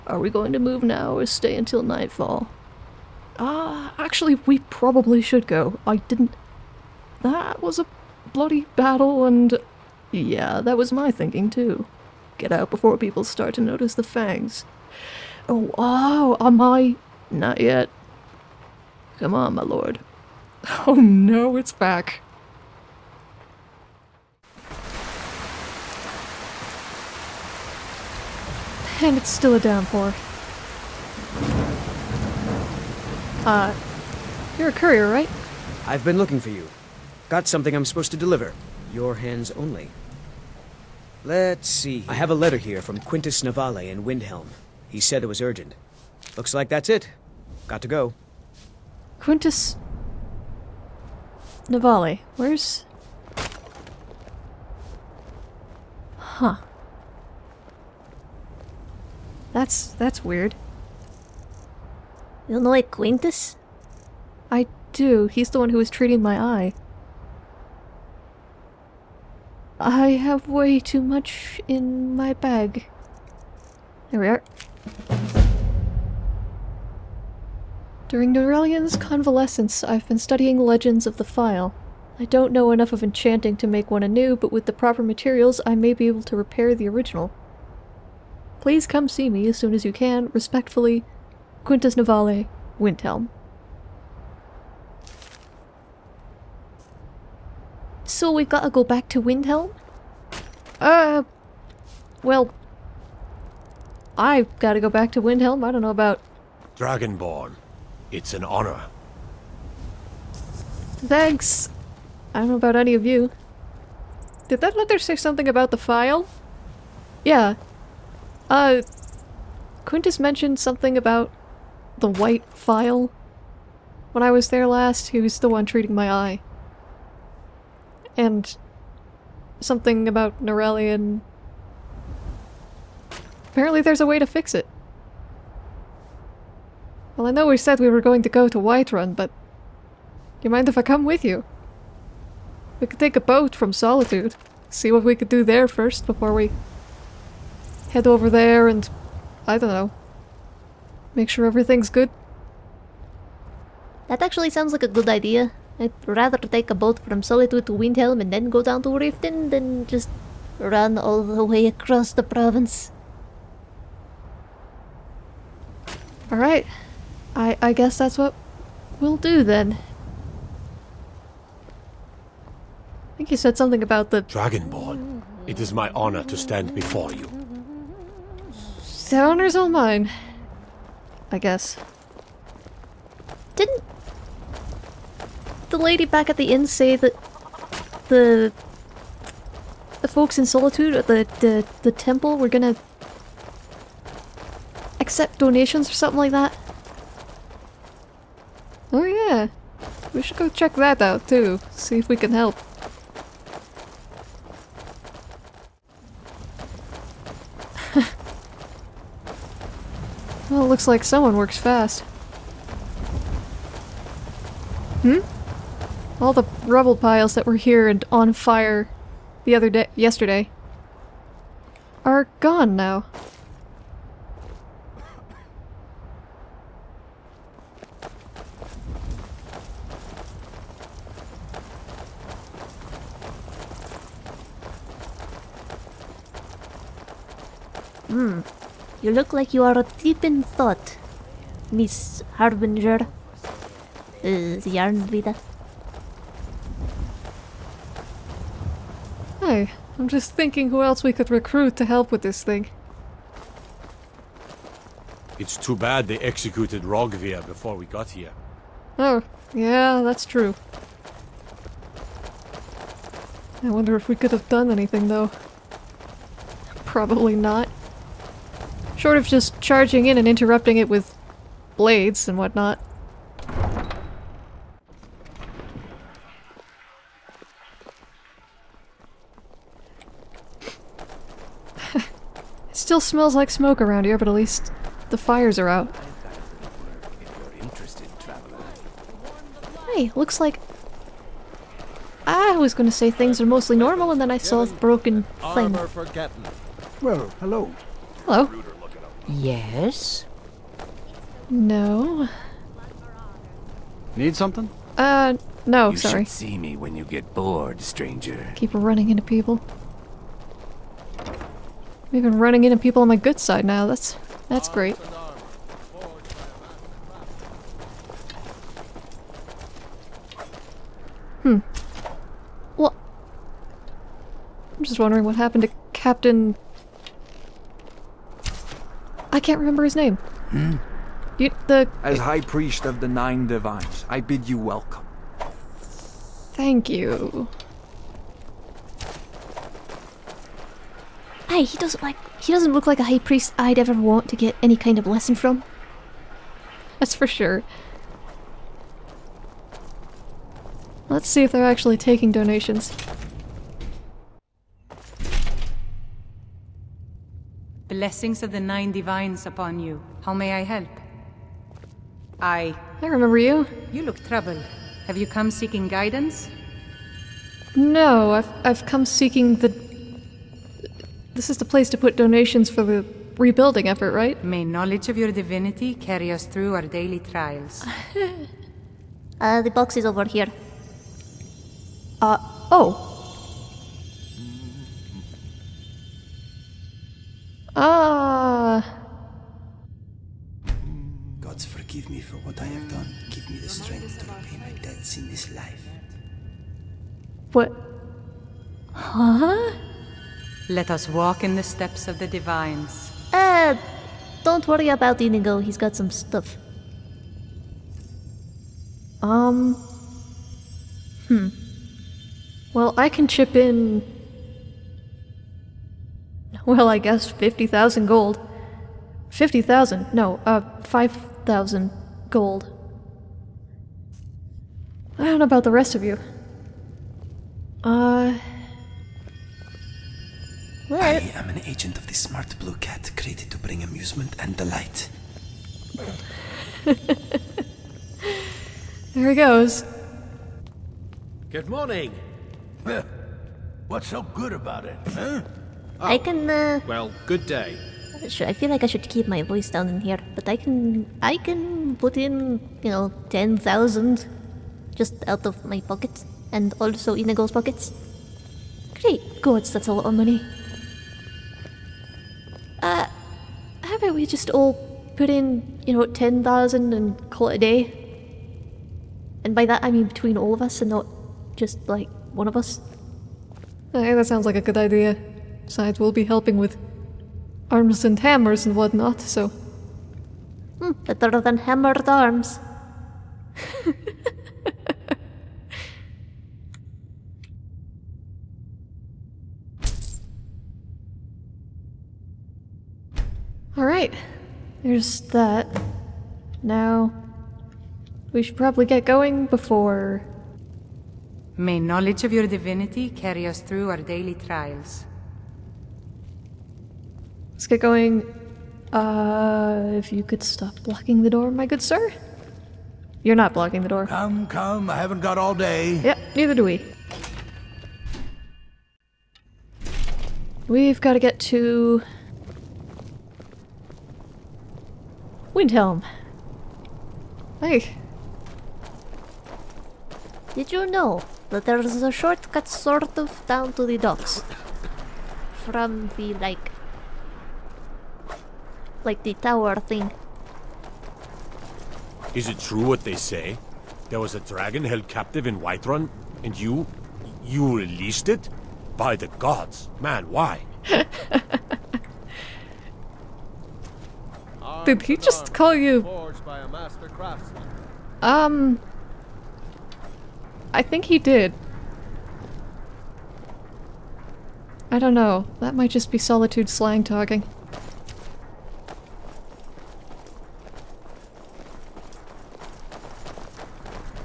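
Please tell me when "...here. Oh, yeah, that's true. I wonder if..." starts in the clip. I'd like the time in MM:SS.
04:18.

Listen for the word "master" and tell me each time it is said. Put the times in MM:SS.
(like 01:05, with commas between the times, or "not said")
not said.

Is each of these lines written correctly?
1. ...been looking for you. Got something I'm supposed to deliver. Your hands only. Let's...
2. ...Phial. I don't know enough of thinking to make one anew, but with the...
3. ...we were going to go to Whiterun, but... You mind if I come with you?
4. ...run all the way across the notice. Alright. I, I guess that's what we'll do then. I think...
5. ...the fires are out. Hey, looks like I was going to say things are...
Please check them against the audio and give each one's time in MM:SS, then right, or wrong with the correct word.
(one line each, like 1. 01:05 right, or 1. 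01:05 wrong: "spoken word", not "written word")
1. 00:36 right
2. 01:21 wrong: "enchanting", not "thinking"
3. 02:17 right
4. 02:40 wrong: "province", not "notice"
5. 04:45 right.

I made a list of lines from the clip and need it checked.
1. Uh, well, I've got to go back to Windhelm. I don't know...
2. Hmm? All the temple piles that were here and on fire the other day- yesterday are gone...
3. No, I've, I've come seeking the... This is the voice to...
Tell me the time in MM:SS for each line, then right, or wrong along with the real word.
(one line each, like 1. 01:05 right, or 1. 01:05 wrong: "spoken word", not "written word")
1. 01:40 right
2. 03:35 wrong: "rubble", not "temple"
3. 06:07 wrong: "place", not "voice".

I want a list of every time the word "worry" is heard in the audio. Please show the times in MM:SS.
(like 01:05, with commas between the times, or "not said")
06:44.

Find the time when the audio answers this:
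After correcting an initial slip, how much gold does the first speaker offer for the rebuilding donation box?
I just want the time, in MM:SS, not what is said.
07:00.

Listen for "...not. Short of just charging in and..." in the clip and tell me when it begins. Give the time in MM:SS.
04:27.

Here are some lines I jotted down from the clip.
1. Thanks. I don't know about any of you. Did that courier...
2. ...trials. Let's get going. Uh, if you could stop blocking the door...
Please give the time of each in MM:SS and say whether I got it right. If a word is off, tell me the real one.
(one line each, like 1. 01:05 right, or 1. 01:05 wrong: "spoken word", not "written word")
1. 01:50 wrong: "letter", not "courier"
2. 08:24 right.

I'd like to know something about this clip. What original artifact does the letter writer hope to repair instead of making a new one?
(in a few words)
The White Phial.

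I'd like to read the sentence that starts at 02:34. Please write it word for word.
That actually sounds like a good idea.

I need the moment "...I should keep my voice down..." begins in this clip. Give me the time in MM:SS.
07:28.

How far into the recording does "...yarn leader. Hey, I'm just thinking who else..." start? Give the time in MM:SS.
04:04.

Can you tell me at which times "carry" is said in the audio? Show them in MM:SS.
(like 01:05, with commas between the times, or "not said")
06:15, 08:23.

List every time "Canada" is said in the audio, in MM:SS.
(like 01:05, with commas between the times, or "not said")
not said.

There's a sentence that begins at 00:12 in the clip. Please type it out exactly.
Get out before people start to notice the fangs.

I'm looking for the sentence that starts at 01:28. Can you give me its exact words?
Please come see me as soon as you can, respectfully, Quintus Navale, Windhelm.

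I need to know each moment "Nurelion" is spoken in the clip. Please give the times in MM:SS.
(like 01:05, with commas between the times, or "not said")
01:18, 02:10.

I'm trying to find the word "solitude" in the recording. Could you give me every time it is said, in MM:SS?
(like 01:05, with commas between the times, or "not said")
02:23, 02:37, 03:10, 09:26.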